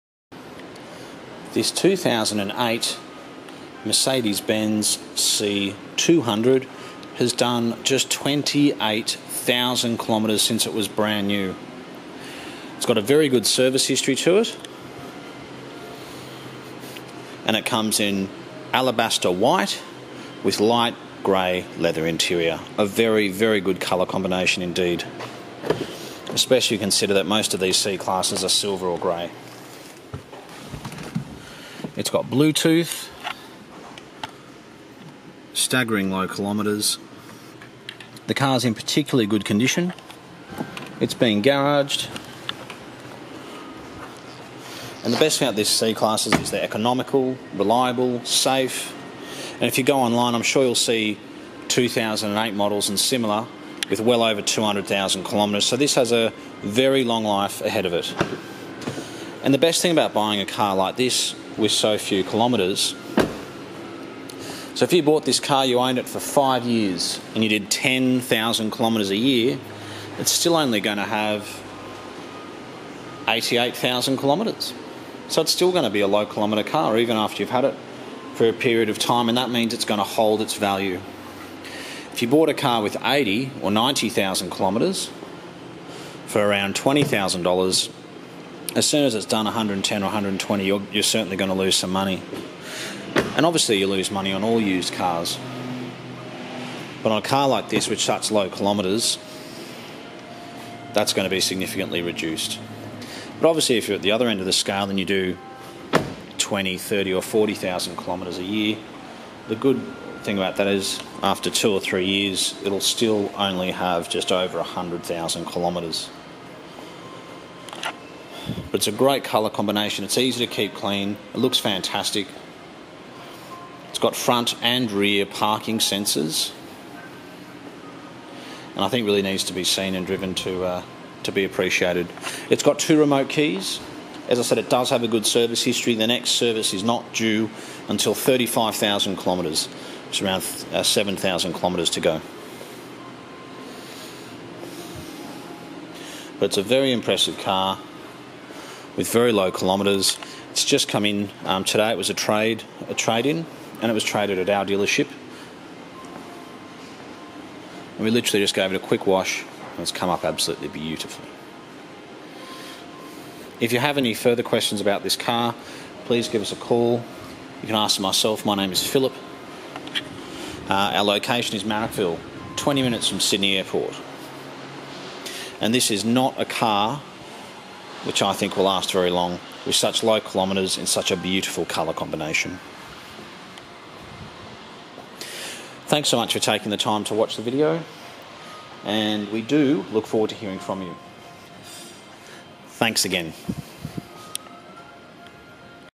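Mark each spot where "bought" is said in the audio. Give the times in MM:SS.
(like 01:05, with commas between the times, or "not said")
01:05, 01:22.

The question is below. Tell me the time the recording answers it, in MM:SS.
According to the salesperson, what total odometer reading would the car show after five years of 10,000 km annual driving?
01:13.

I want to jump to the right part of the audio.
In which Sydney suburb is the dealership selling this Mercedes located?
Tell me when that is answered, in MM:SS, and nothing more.
02:51.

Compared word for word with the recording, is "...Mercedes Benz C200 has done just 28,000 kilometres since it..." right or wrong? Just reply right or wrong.
right.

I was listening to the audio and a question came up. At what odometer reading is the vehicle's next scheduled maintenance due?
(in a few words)
35,000 kilometres.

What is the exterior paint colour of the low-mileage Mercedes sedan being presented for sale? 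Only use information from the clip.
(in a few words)
Alabaster white.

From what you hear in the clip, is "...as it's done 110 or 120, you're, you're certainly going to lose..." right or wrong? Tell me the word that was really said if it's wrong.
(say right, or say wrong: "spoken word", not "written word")
right.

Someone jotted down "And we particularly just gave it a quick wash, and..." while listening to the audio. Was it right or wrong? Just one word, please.
wrong.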